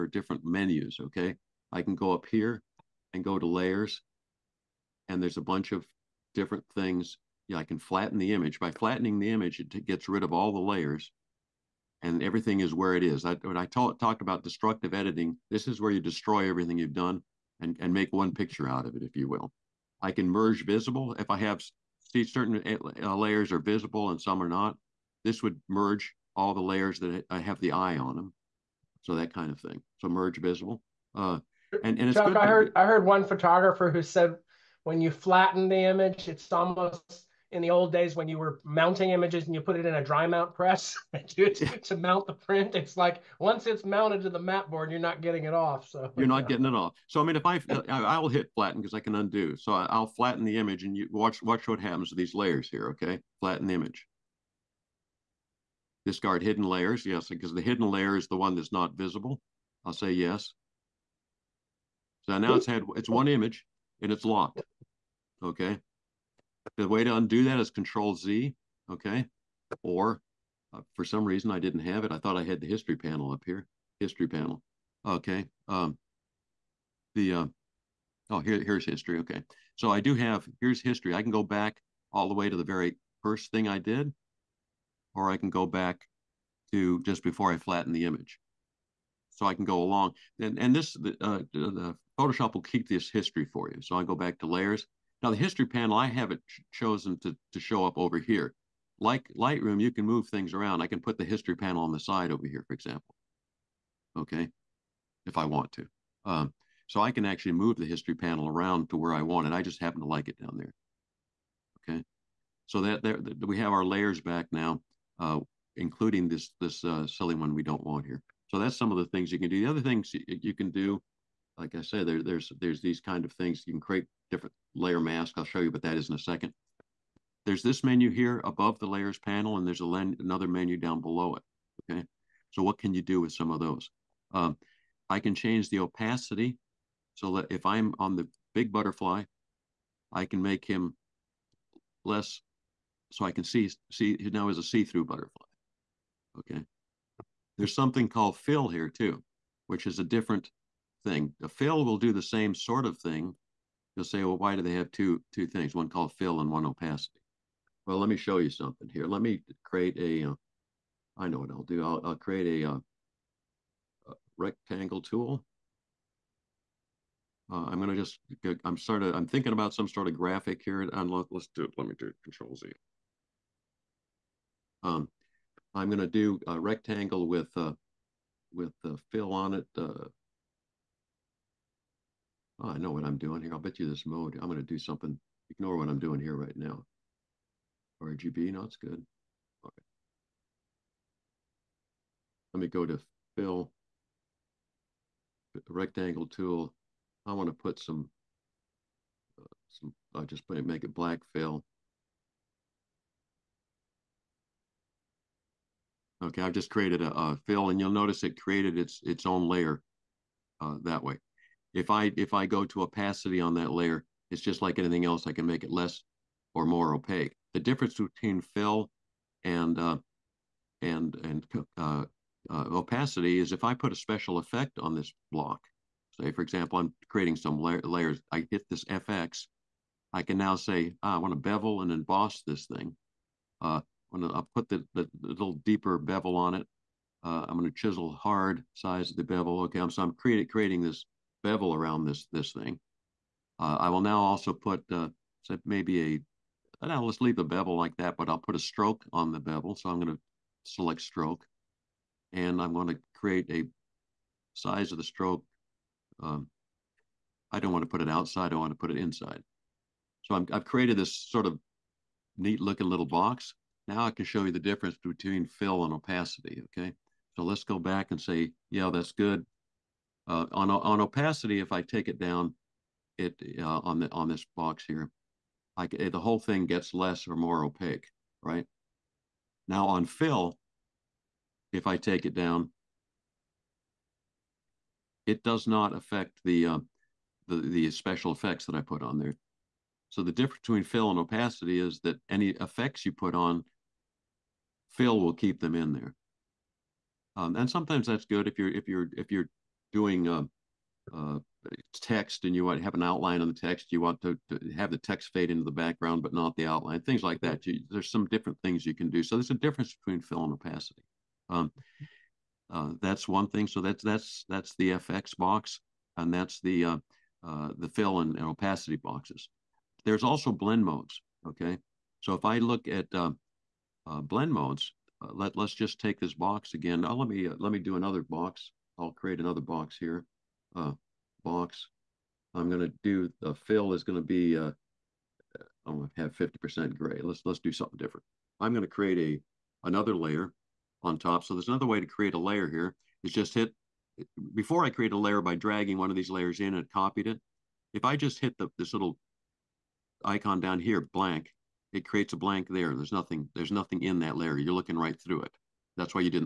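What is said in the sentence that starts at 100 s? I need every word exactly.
I can put the history panel on the side over here, for example.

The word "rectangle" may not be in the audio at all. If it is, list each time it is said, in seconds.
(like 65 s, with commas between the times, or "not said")
164 s, 176 s, 195 s.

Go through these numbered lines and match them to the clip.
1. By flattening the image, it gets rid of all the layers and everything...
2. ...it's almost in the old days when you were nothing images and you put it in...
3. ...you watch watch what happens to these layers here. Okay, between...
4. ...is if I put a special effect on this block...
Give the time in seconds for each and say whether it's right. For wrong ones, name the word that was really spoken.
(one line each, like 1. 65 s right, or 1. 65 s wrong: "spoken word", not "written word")
1. 8 s right
2. 36 s wrong: "mounting", not "nothing"
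3. 50 s wrong: "flatten", not "between"
4. 223 s right.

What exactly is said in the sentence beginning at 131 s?
Okay, so what can you do with some of those?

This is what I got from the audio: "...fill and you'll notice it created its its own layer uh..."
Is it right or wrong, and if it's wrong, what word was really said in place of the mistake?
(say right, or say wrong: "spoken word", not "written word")
right.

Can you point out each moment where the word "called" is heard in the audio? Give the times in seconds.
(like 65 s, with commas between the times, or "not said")
148 s, 155 s.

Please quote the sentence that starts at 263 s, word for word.
Now I can show you the difference between fill and opacity, okay?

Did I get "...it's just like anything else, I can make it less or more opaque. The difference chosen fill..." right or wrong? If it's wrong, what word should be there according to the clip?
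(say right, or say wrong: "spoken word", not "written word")
wrong: "between", not "chosen".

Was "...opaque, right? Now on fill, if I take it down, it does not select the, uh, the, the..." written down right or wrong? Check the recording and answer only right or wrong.
wrong.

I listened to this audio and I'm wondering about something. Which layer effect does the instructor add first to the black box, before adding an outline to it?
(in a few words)
bevel and emboss.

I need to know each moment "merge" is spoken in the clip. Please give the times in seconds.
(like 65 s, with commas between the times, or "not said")
20 s, 25 s, 30 s.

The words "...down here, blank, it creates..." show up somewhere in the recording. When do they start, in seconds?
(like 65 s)
350 s.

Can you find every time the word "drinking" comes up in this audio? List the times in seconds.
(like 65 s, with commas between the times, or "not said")
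not said.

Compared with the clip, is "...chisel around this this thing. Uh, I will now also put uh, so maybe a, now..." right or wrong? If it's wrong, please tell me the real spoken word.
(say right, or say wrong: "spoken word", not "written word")
wrong: "bevel", not "chisel".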